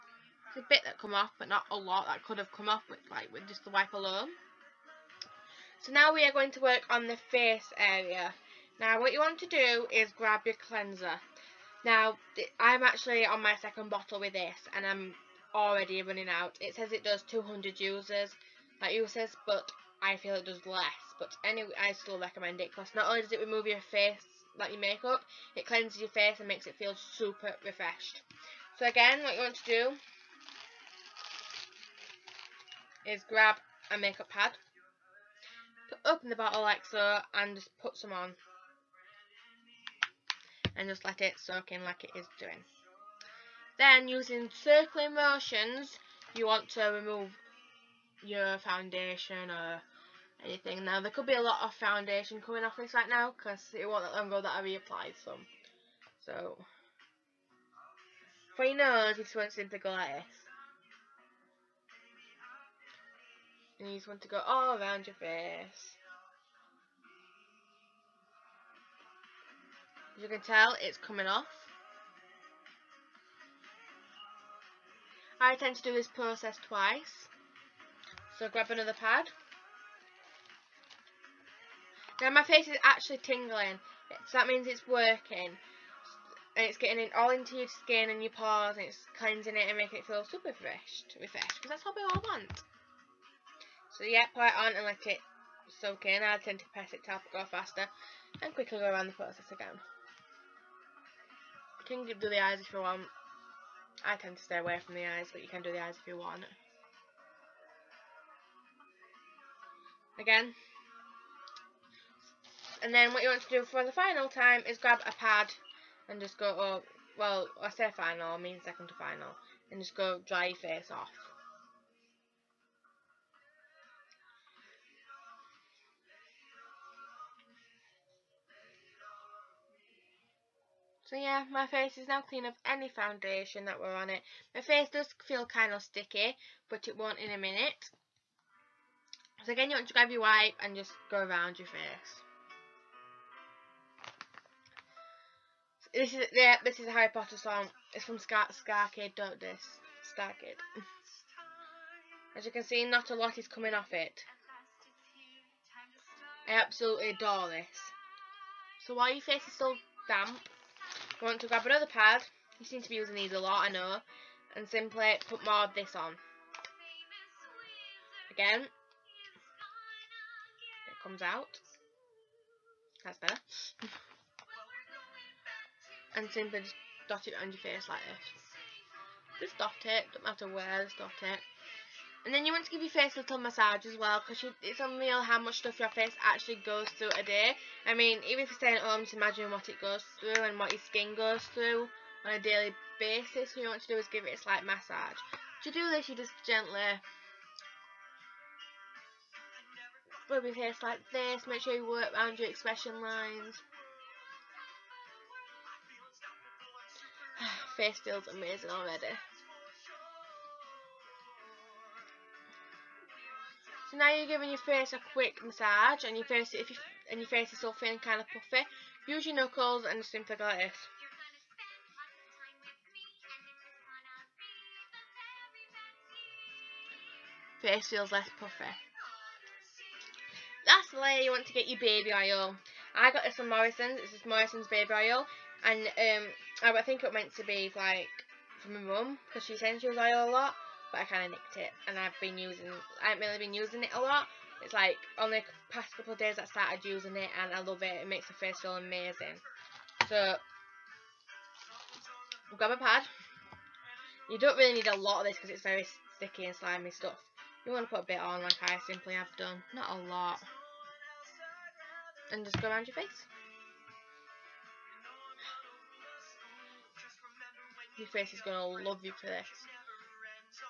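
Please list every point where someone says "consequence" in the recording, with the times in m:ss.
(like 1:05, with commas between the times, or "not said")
not said.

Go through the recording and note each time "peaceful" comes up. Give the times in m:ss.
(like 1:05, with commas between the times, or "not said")
not said.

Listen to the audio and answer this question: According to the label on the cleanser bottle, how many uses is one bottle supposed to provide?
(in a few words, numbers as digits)
200.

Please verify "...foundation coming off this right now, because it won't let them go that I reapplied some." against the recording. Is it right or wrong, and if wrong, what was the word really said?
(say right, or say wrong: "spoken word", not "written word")
right.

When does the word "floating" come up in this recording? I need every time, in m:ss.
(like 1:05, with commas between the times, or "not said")
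not said.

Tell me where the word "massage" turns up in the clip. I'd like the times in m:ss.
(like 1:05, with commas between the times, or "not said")
3:03, 3:14, 3:35.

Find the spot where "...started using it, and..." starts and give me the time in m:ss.
4:06.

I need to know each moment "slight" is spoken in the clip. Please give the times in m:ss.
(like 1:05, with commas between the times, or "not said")
3:14.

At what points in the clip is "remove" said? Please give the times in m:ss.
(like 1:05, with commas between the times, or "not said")
0:23, 0:46.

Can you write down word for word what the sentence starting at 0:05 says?
So now we are going to work on the face area.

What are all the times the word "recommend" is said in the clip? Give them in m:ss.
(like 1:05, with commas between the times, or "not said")
0:22.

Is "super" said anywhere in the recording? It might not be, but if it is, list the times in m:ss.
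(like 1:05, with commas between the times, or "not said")
0:27, 1:30.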